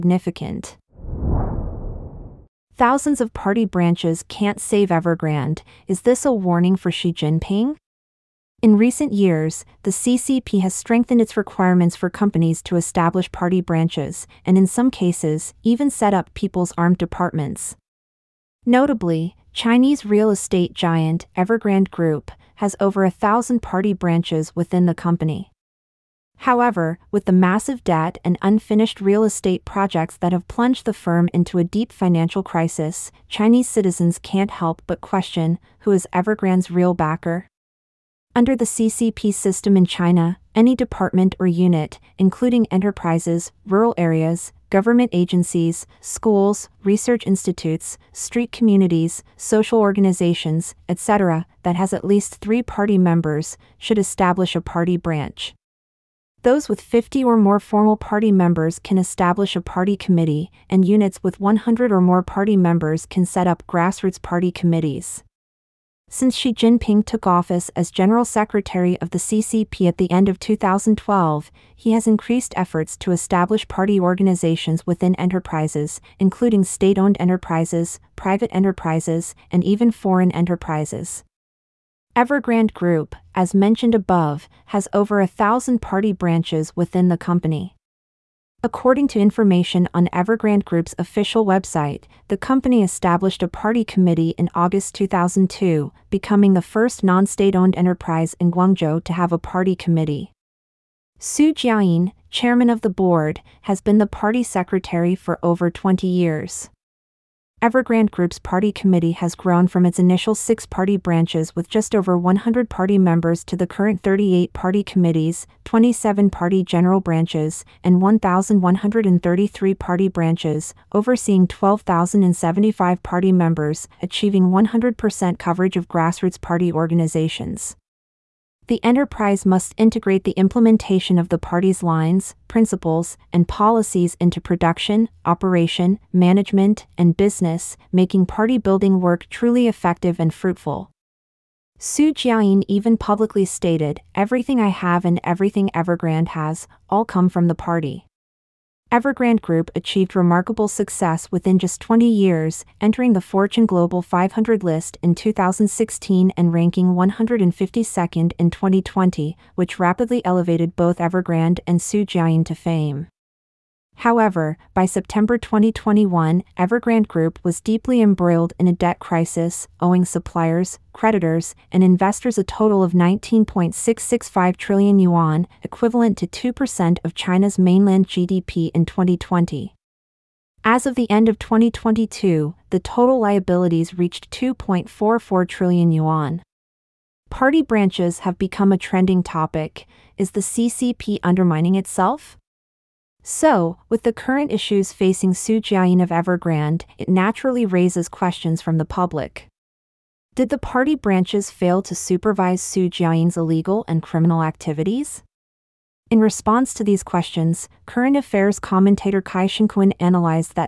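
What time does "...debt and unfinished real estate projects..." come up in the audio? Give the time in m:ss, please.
0:27.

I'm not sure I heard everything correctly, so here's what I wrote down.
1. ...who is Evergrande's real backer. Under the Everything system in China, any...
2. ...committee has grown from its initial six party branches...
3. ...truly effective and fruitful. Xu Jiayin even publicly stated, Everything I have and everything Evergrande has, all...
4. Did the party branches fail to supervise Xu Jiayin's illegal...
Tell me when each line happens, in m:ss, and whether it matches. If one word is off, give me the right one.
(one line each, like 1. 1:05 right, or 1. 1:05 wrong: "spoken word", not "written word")
1. 0:35 wrong: "CCP", not "Everything"
2. 1:48 right
3. 2:19 right
4. 3:20 right.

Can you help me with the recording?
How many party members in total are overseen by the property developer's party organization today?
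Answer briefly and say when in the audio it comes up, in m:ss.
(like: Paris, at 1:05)
12,075, at 2:01.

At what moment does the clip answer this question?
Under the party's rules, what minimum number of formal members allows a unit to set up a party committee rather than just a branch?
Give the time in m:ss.
0:56.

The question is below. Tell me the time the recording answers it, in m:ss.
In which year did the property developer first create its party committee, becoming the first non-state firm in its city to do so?
1:34.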